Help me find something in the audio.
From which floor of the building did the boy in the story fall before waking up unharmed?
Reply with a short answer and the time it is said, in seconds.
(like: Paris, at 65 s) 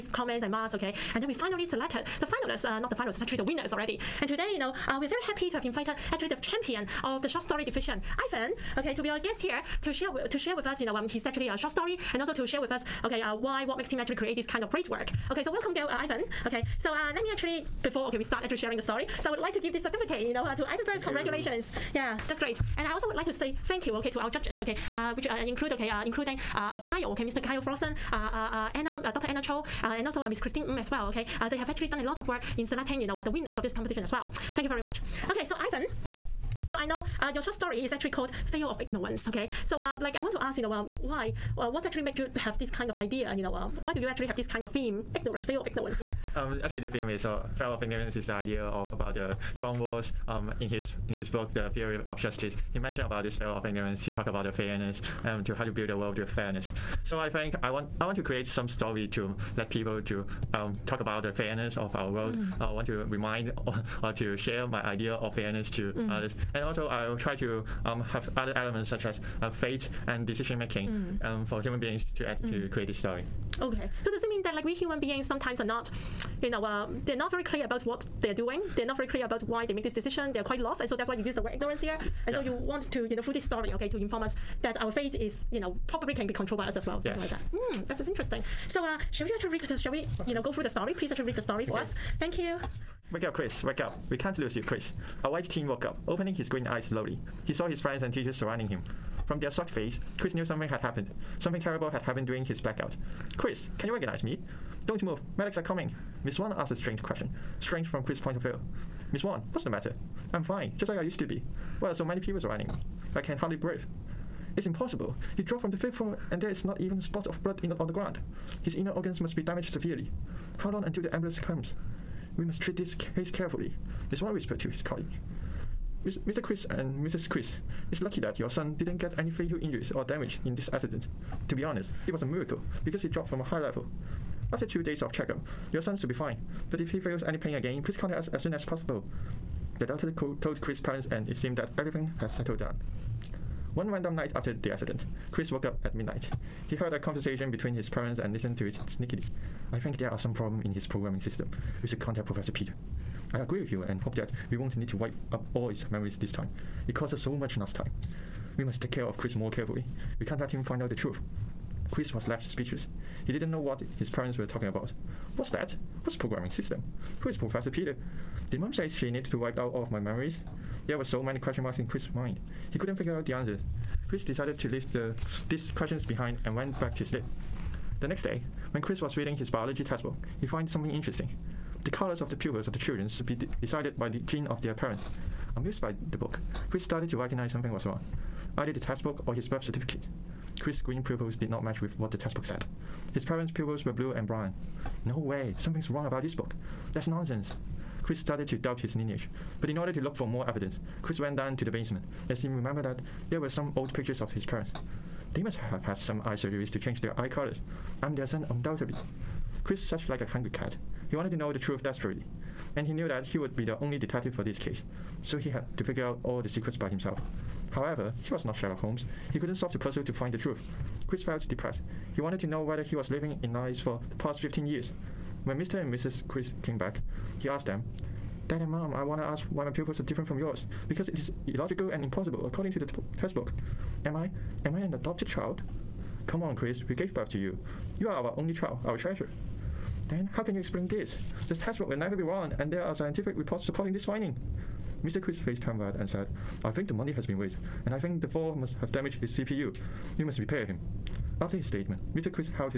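fifth floor, at 115 s.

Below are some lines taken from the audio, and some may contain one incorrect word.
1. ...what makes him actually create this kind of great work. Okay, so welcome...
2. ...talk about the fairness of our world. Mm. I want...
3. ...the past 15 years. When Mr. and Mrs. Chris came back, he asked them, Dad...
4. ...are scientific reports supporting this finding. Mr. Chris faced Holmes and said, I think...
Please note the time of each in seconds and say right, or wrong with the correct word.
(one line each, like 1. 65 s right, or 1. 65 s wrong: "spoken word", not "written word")
1. 13 s right
2. 60 s right
3. 224 s right
4. 242 s wrong: "Tamrat", not "Holmes".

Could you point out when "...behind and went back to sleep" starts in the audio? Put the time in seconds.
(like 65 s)
176 s.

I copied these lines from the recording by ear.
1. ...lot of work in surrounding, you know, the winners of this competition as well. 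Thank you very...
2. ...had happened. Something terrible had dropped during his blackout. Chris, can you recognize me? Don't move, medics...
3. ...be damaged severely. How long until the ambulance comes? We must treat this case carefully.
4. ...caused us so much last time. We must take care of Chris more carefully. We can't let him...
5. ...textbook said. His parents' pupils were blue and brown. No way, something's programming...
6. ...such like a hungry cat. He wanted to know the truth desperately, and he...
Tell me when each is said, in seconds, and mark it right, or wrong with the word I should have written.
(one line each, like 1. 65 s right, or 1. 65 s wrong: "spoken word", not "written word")
1. 32 s wrong: "selecting", not "surrounding"
2. 100 s wrong: "happened", not "dropped"
3. 119 s right
4. 156 s right
5. 192 s wrong: "wrong", not "programming"
6. 209 s right.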